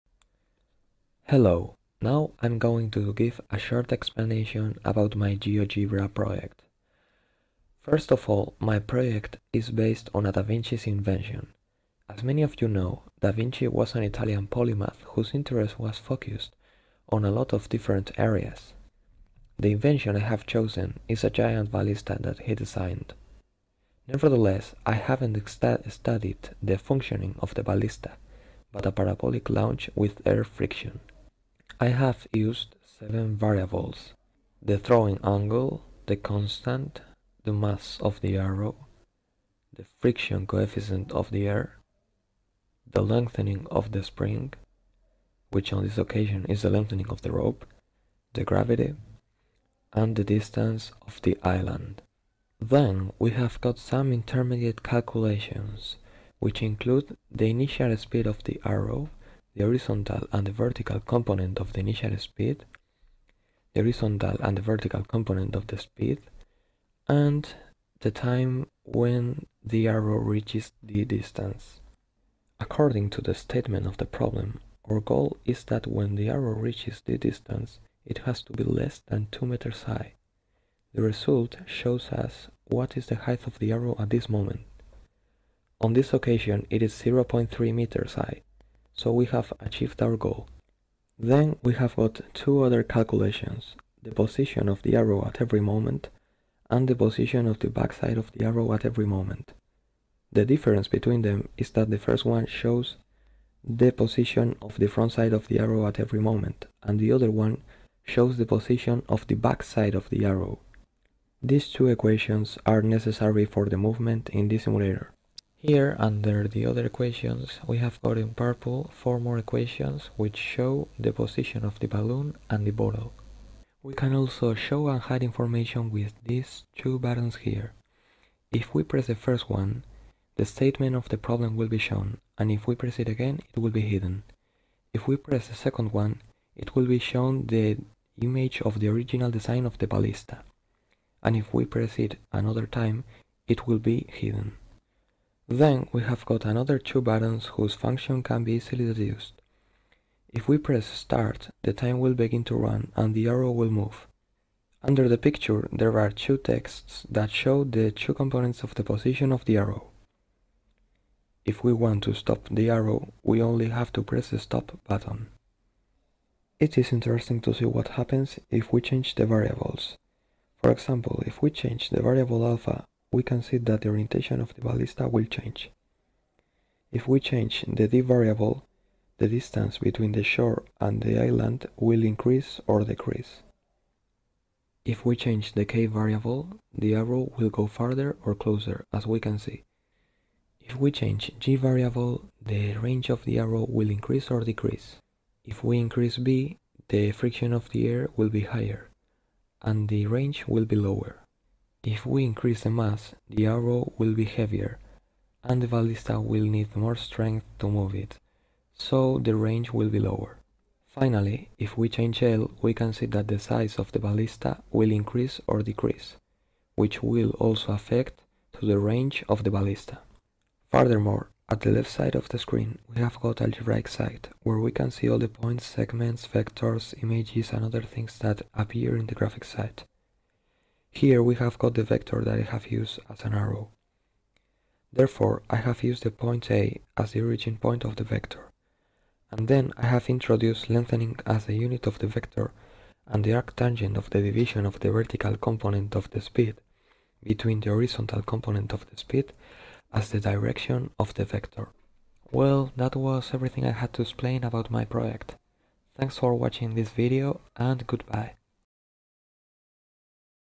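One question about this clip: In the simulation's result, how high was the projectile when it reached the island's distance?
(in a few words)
0.3 meters.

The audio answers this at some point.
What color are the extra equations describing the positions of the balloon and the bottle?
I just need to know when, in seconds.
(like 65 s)
118 s.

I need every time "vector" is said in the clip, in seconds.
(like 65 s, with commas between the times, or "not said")
226 s, 231 s, 238 s, 242 s, 251 s.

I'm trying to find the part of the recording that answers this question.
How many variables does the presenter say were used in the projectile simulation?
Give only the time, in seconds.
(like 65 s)
32 s.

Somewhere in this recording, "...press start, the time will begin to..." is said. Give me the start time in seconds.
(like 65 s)
150 s.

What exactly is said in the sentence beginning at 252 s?
Well, that was everything I had to explain about my project.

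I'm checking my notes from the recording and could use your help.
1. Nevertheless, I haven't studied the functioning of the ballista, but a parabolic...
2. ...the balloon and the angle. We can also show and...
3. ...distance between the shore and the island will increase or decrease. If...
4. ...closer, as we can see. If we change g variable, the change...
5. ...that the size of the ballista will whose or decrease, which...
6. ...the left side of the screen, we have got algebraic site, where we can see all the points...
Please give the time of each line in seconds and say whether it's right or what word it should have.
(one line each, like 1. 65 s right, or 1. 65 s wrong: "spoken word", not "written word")
1. 24 s right
2. 121 s wrong: "bottle", not "angle"
3. 179 s right
4. 188 s wrong: "range", not "change"
5. 213 s wrong: "increase", not "whose"
6. 221 s right.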